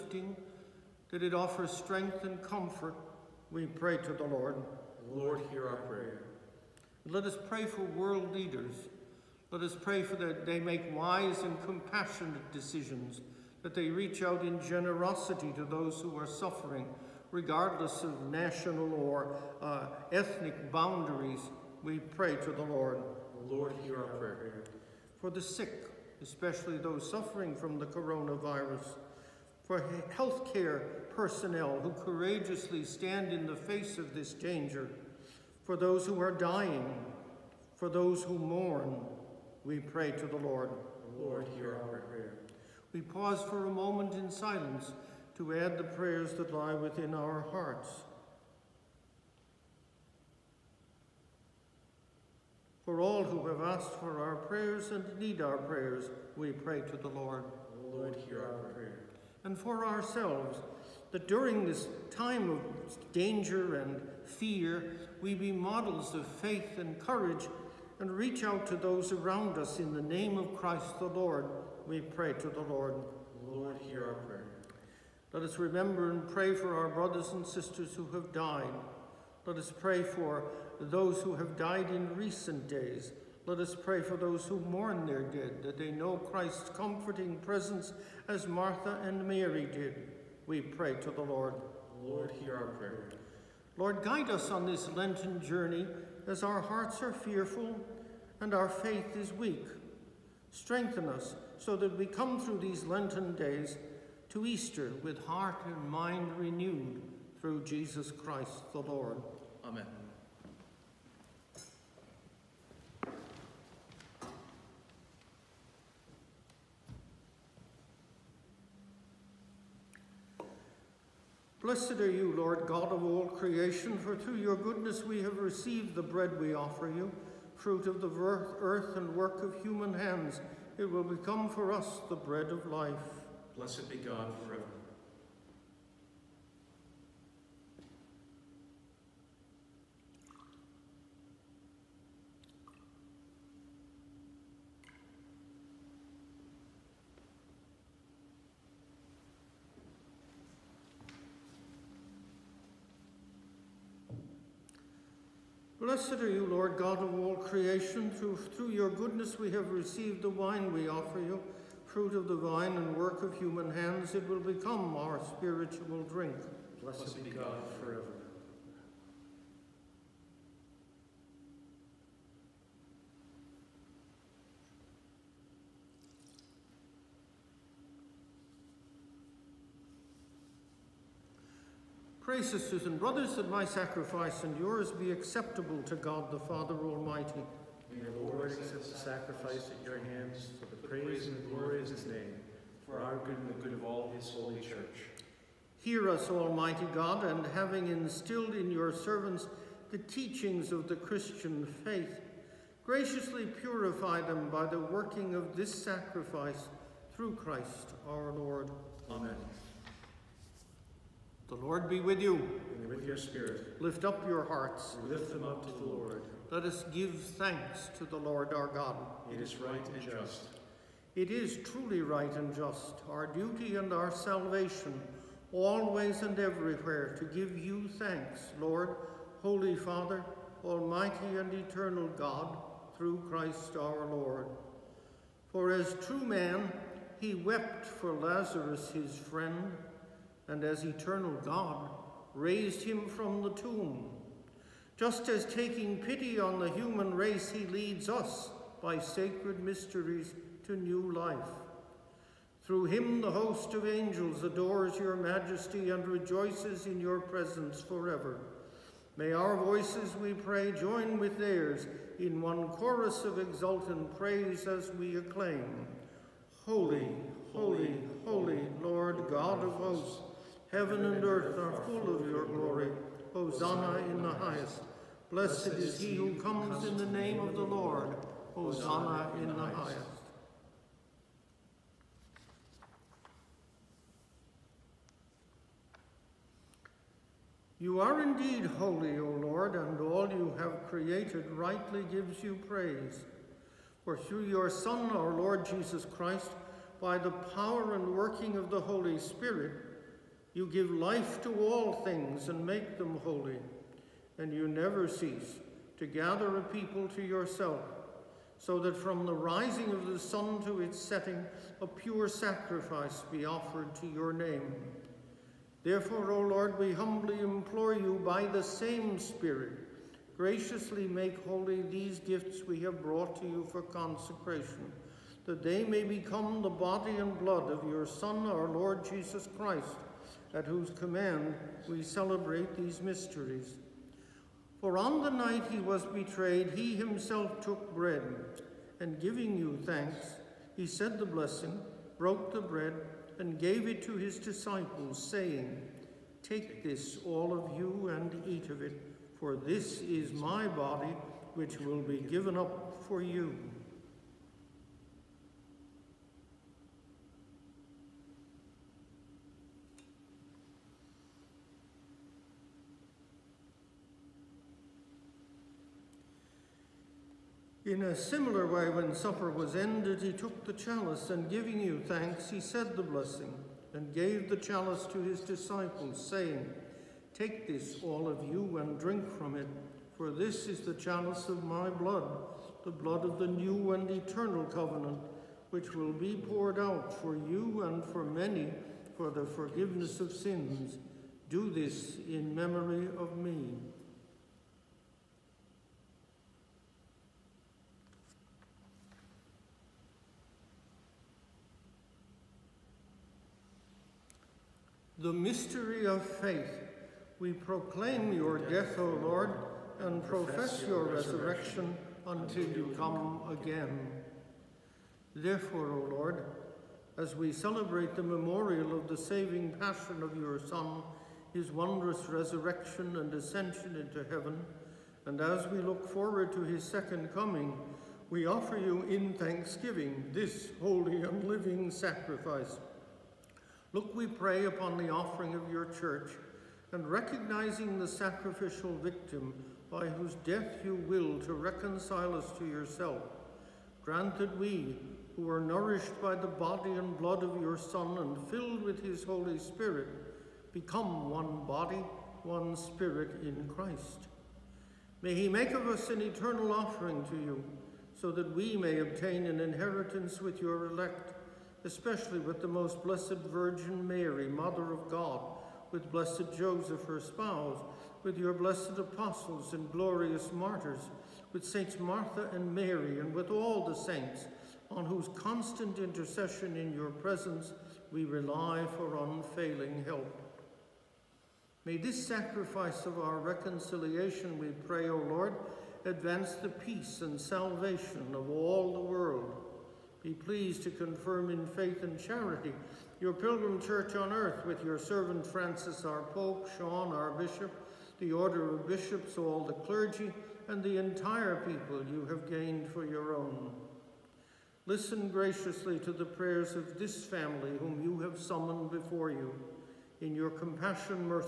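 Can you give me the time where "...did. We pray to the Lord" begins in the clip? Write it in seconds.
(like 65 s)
89 s.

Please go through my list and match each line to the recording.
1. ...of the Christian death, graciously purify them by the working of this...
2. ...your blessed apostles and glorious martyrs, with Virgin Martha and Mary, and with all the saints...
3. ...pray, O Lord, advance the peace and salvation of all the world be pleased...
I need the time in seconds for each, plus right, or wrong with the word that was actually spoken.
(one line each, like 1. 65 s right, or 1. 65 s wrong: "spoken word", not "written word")
1. 200 s wrong: "faith", not "death"
2. 468 s wrong: "Saints", not "Virgin"
3. 484 s right.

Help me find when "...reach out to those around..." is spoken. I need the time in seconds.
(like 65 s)
68 s.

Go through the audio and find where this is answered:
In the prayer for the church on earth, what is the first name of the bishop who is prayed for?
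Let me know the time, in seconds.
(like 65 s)
496 s.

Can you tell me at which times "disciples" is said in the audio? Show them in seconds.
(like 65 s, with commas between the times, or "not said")
344 s, 375 s.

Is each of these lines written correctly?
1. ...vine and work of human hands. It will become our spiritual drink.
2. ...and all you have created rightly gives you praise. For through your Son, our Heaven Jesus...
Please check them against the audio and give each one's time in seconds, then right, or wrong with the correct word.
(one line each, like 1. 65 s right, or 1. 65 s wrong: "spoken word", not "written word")
1. 162 s right
2. 289 s wrong: "Lord", not "Heaven".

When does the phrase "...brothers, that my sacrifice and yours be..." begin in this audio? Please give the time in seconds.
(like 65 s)
182 s.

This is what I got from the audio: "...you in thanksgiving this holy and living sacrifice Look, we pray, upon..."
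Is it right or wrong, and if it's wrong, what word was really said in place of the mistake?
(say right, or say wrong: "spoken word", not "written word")
right.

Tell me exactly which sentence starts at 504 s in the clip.
Listen graciously to the prayers of this family whom you have summoned before you.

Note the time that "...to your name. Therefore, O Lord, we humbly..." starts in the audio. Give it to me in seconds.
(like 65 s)
313 s.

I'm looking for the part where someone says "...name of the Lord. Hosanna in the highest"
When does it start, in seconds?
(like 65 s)
277 s.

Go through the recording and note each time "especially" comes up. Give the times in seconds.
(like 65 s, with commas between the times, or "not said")
26 s, 461 s.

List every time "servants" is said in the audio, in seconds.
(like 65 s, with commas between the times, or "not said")
198 s, 494 s.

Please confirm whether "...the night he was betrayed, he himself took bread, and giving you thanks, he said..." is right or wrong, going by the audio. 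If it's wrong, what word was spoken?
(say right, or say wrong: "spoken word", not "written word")
right.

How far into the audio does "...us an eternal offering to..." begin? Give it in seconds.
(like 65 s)
455 s.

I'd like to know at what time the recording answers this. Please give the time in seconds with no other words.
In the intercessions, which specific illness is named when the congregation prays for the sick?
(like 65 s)
27 s.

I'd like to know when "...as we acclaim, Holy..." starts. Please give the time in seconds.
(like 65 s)
264 s.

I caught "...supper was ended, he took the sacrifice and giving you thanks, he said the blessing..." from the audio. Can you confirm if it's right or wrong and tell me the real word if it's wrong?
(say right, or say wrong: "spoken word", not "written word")
wrong: "chalice", not "sacrifice".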